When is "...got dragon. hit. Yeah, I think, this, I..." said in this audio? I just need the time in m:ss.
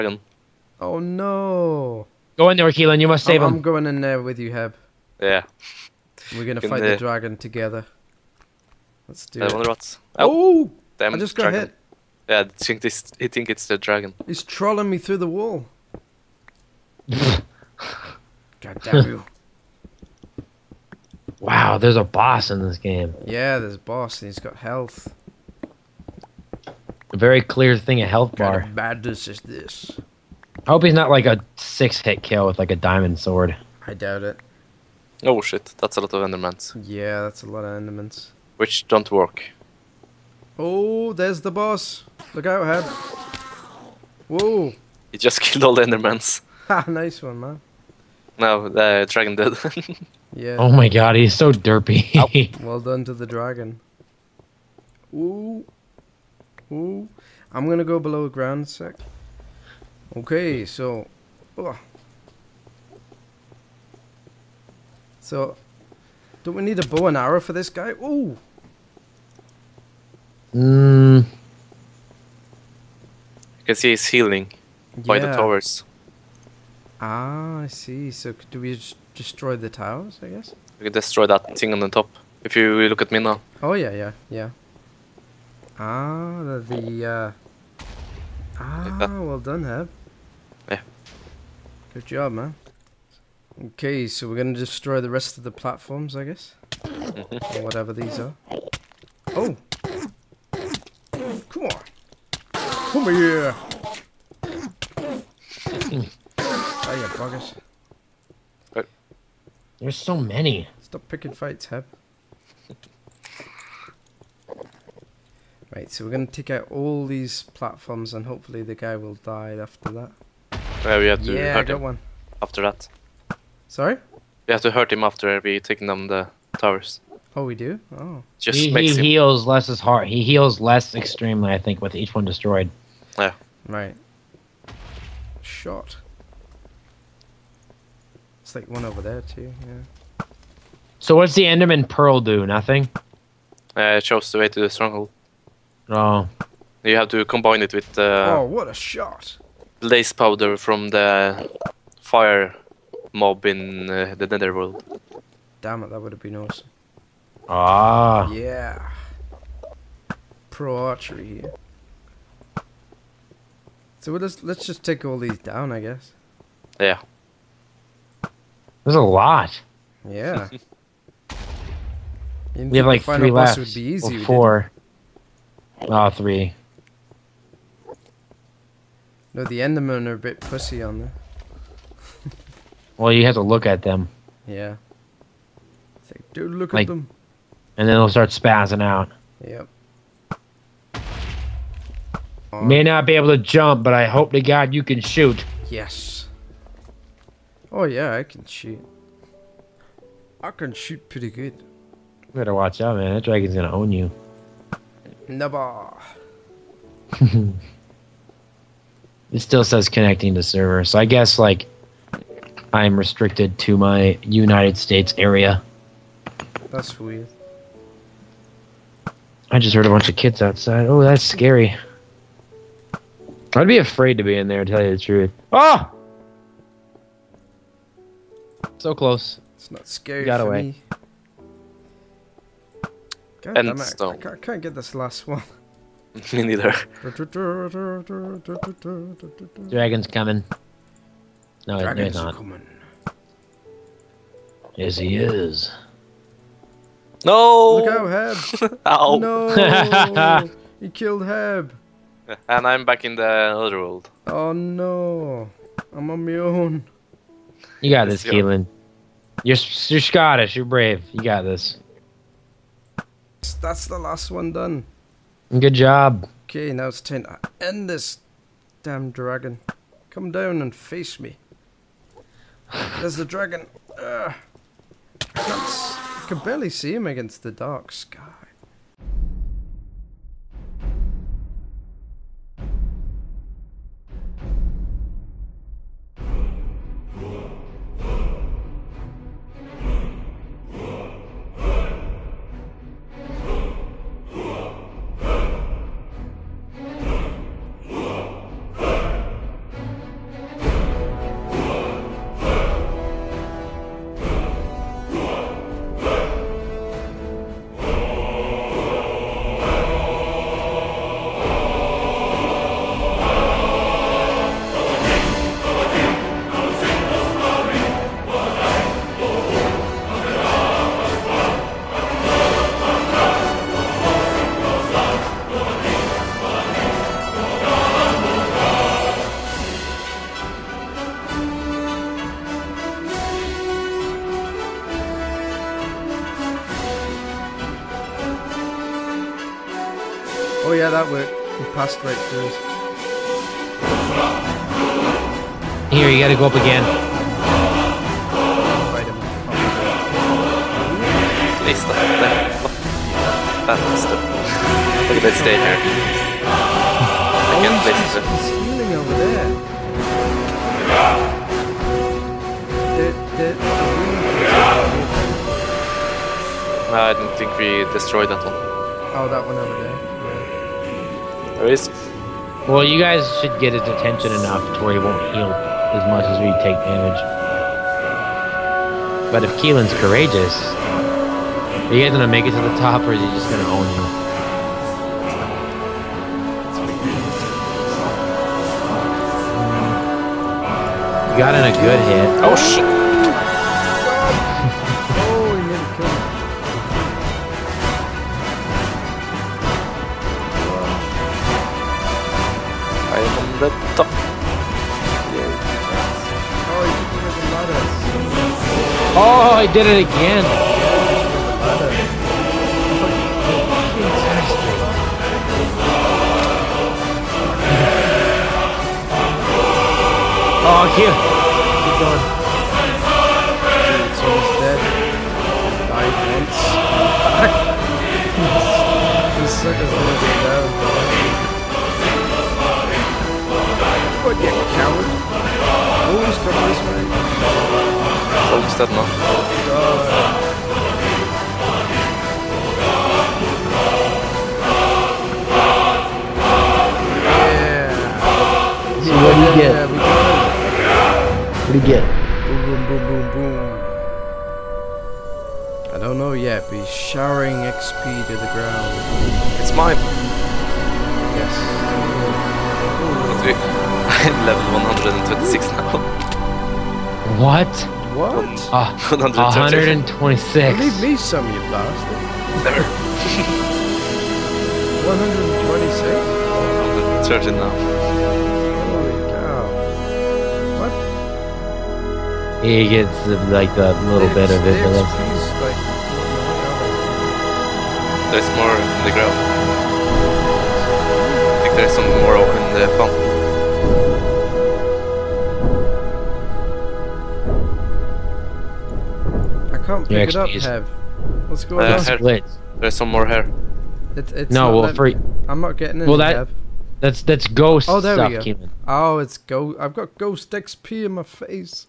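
0:11.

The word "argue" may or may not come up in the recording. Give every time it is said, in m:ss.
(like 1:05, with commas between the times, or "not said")
not said.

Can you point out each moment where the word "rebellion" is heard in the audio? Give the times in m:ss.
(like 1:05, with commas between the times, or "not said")
not said.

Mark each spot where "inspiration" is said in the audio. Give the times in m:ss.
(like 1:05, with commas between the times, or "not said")
not said.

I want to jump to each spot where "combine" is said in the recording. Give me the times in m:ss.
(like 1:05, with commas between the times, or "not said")
2:27.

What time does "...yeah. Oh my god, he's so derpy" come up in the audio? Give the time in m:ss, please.
0:50.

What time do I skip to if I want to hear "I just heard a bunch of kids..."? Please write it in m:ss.
3:39.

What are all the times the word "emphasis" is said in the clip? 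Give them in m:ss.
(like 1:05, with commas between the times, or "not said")
not said.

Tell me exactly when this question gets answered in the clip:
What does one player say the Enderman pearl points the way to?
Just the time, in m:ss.
2:24.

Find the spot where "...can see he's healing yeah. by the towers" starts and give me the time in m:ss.
1:13.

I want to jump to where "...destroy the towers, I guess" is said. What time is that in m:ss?
1:19.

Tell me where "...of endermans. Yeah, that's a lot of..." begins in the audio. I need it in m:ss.
0:36.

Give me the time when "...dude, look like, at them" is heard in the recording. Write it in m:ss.
3:06.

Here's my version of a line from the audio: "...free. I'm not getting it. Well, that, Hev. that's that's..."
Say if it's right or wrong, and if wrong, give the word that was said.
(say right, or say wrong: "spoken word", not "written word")
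right.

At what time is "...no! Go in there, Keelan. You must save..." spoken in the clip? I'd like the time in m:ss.
0:00.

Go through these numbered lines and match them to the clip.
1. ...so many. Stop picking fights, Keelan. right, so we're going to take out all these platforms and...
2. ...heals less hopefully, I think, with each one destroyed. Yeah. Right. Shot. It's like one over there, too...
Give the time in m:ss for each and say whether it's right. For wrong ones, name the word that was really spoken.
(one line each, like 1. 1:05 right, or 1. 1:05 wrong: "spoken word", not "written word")
1. 1:49 wrong: "Heb", not "Keelan"
2. 2:10 wrong: "extremely", not "hopefully".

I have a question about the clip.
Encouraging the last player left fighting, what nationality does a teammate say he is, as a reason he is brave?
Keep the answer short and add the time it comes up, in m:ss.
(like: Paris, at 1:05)
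Scottish, at 4:20.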